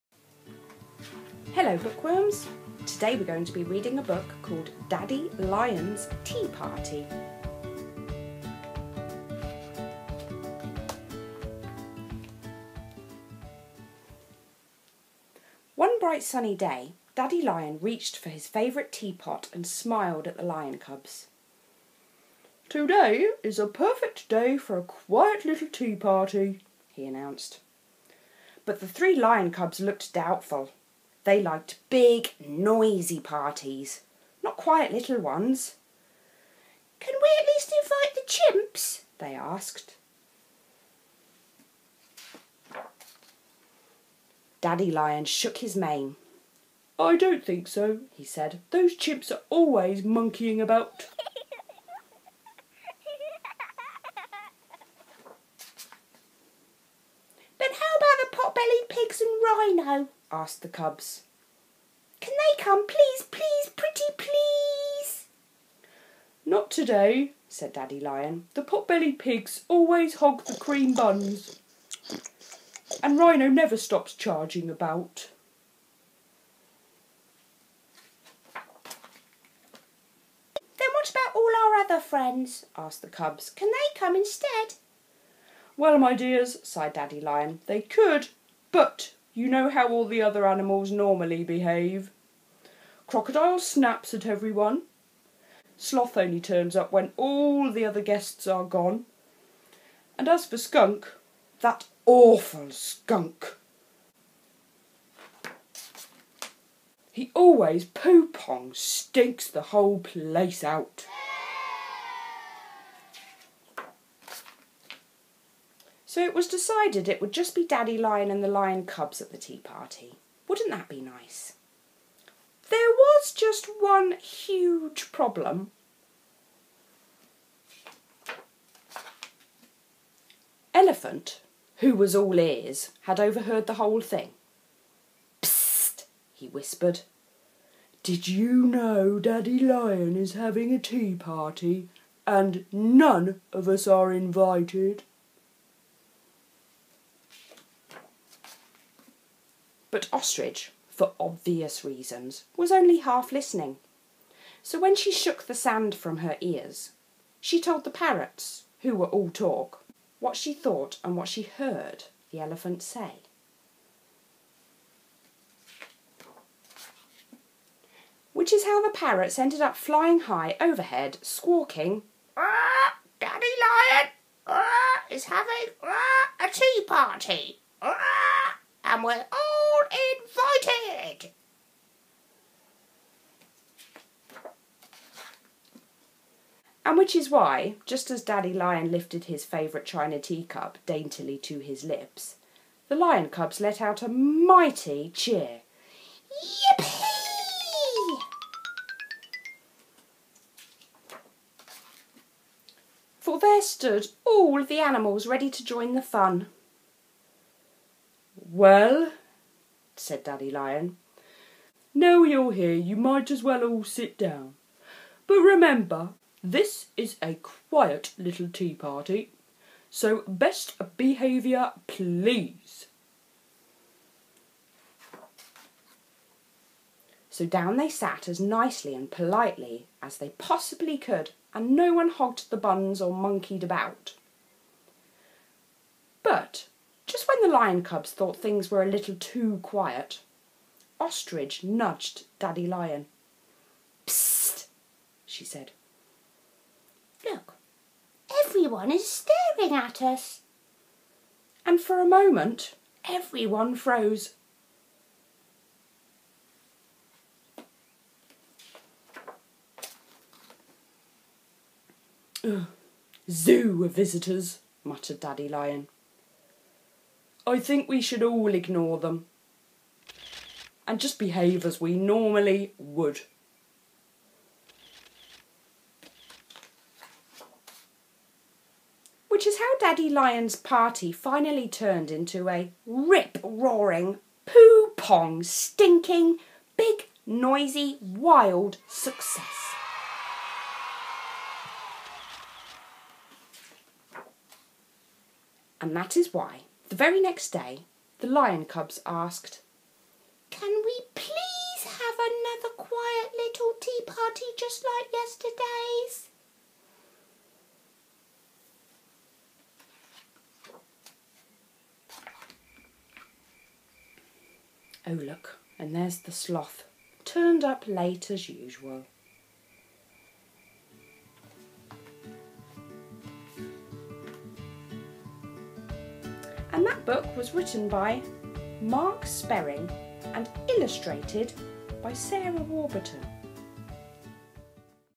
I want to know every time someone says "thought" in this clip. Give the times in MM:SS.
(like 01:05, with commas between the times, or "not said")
02:40, 03:58.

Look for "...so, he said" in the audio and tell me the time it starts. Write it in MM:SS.
00:47.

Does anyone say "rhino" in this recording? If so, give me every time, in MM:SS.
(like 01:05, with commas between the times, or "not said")
00:59, 01:13.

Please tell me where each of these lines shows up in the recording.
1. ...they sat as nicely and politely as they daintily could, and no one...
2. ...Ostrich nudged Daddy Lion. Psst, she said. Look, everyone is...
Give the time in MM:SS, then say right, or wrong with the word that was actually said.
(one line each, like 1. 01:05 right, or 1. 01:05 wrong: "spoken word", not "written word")
1. 03:47 wrong: "possibly", not "daintily"
2. 04:00 right.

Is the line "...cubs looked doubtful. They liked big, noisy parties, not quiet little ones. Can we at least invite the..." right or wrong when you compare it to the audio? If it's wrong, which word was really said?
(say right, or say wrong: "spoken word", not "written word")
right.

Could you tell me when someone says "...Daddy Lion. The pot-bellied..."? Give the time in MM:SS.
01:07.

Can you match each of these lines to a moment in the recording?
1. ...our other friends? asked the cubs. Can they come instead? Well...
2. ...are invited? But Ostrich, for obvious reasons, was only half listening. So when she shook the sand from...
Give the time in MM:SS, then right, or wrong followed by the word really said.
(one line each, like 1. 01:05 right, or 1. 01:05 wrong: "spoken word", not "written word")
1. 01:21 right
2. 02:23 right.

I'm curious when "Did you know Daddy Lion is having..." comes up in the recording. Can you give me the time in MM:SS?
02:18.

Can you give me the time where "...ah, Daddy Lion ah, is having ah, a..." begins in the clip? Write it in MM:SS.
02:52.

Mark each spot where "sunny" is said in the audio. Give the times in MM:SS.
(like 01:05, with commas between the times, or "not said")
00:16.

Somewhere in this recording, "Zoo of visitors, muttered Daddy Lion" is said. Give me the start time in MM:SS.
04:23.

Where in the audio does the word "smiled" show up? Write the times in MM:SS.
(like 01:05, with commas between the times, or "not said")
00:19.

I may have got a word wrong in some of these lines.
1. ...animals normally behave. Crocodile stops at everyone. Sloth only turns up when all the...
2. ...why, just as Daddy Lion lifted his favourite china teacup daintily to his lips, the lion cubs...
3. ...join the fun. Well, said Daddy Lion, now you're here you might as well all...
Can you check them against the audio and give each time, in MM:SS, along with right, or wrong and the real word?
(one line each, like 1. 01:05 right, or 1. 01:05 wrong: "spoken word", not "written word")
1. 01:30 wrong: "snaps", not "stops"
2. 03:07 right
3. 03:25 right.